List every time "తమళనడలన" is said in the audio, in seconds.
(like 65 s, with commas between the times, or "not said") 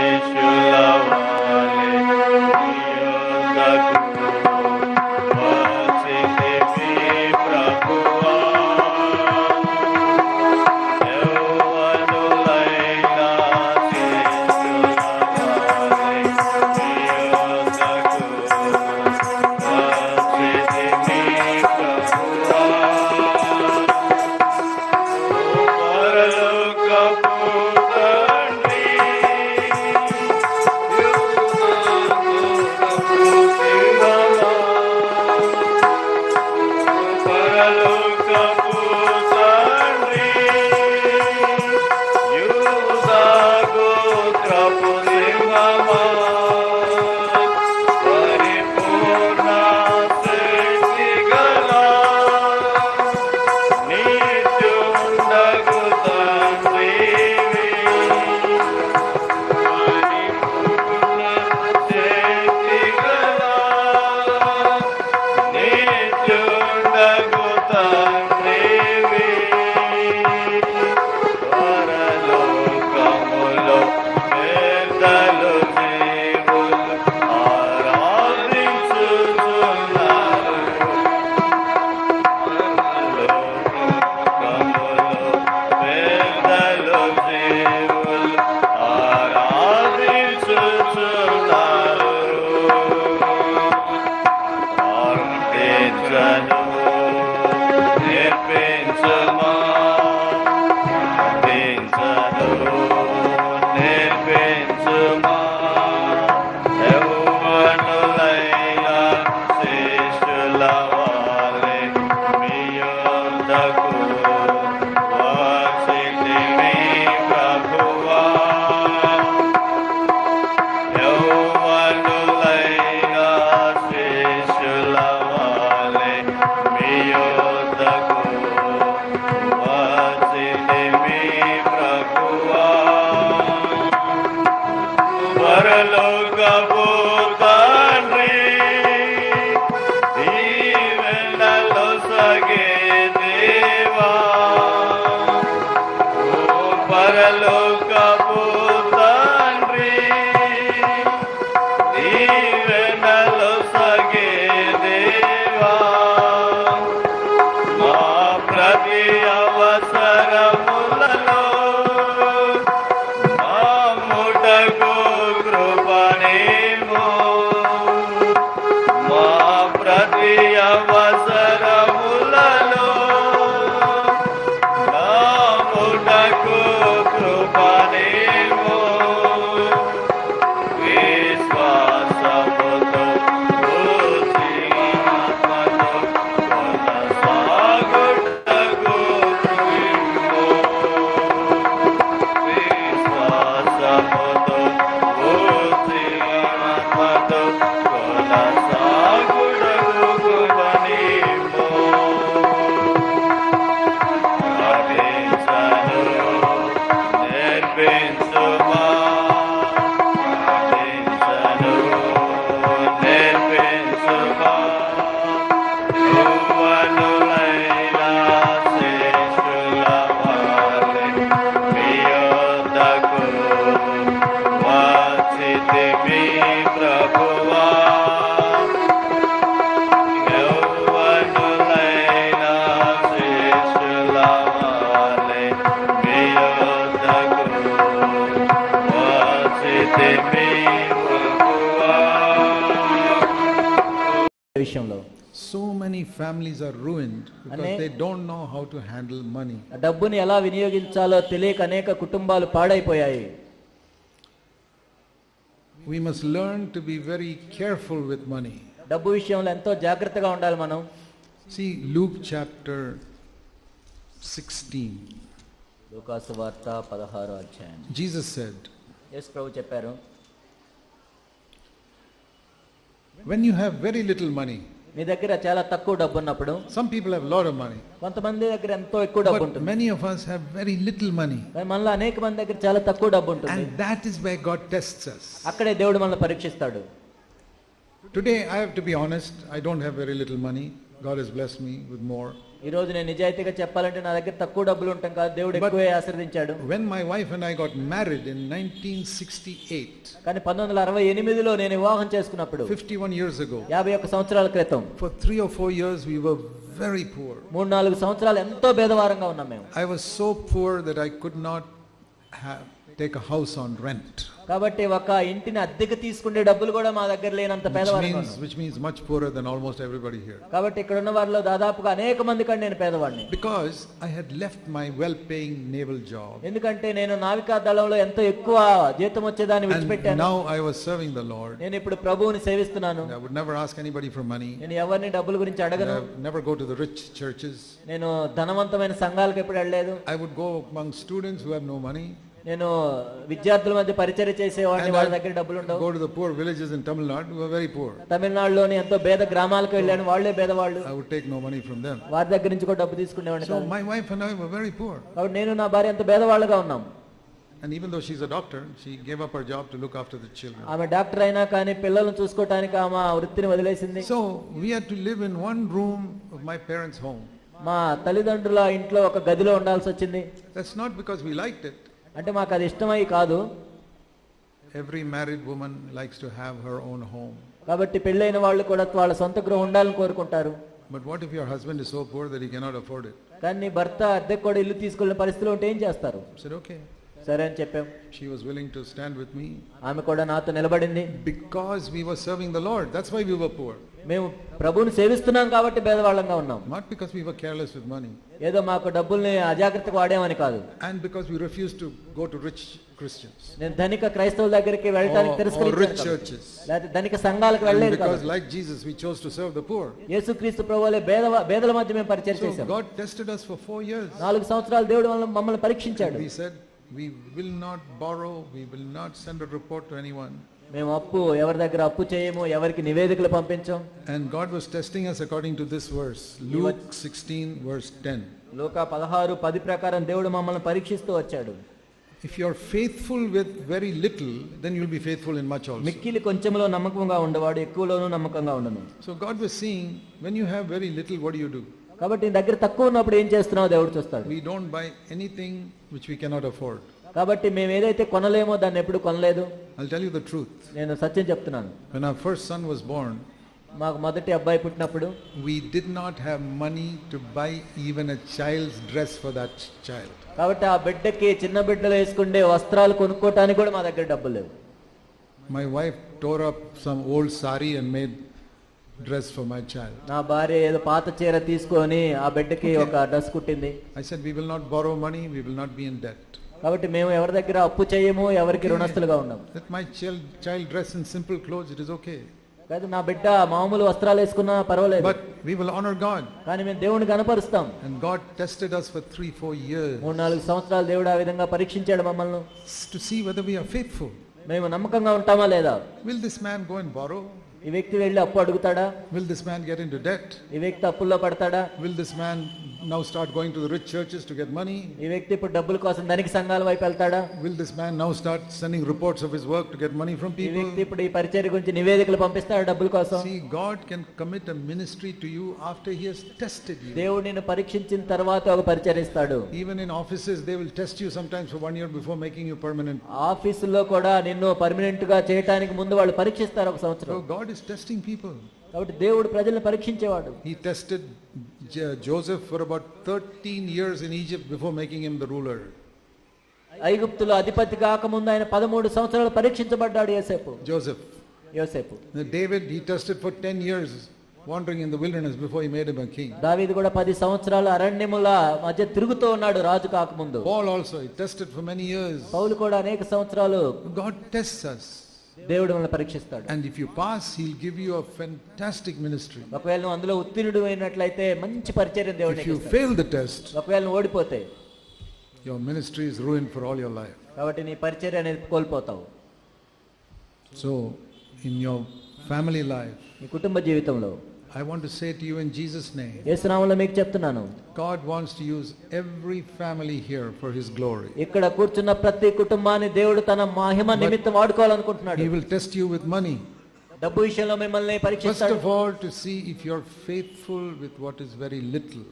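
348 s.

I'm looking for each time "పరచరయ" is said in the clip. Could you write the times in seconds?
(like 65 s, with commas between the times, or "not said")
511 s, 518 s, 561 s, 567 s.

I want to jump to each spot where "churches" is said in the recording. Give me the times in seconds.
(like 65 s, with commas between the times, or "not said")
503 s.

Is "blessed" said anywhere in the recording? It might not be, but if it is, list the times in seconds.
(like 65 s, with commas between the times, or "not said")
291 s.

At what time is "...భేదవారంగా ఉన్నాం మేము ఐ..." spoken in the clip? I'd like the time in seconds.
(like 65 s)
308 s.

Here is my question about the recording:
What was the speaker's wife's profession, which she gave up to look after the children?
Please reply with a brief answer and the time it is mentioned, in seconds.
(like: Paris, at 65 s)
Doctor, at 358 s.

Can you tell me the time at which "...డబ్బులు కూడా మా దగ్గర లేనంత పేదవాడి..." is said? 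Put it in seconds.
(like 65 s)
316 s.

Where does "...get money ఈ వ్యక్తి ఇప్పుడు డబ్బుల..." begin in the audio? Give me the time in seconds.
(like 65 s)
504 s.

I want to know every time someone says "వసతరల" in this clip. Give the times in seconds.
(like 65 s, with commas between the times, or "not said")
462 s, 483 s.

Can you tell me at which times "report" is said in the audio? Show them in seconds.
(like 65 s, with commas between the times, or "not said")
419 s, 508 s.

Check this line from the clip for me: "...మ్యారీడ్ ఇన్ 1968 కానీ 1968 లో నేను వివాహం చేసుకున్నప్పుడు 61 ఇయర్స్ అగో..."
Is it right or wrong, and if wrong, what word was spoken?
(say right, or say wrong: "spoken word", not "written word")
wrong: "51", not "61".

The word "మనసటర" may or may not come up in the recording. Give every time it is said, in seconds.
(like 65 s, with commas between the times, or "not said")
559 s, 565 s.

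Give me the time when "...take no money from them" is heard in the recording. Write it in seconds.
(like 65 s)
351 s.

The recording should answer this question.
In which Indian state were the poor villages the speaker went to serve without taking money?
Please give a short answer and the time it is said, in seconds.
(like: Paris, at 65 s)
Tamil Nadu, at 346 s.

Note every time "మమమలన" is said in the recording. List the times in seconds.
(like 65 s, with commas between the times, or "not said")
415 s, 430 s, 492 s.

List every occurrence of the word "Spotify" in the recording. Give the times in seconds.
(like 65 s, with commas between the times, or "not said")
not said.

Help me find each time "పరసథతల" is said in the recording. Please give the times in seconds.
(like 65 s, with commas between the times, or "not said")
385 s.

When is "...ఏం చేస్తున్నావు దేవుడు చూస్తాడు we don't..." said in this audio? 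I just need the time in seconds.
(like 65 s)
443 s.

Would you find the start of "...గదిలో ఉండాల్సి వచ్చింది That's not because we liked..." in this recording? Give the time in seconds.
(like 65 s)
369 s.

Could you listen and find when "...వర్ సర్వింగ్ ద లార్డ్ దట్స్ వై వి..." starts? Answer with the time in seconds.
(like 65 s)
392 s.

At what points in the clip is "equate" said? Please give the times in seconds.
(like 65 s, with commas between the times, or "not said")
not said.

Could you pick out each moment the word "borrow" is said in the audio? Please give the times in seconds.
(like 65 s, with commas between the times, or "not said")
417 s, 497 s.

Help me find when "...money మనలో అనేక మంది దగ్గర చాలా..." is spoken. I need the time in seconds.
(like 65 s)
281 s.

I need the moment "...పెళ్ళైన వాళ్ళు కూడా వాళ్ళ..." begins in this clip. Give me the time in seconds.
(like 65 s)
378 s.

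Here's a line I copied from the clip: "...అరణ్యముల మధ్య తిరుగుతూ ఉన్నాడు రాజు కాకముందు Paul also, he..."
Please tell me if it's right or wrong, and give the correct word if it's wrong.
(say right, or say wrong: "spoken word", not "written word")
right.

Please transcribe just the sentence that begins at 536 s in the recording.
ఐగుప్తులో అధిపతి కాకముందు ఆయన పదమూడు సంవత్సరాలు పరీక్షించబడ్డాడు యోసేపు Joseph.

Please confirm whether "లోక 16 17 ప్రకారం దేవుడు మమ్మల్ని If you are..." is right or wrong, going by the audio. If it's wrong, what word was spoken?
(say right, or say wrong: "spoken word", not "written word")
wrong: "10", not "17".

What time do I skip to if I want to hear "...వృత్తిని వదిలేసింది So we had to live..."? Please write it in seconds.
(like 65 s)
363 s.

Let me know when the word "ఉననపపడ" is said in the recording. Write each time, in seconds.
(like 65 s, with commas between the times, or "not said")
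276 s, 442 s.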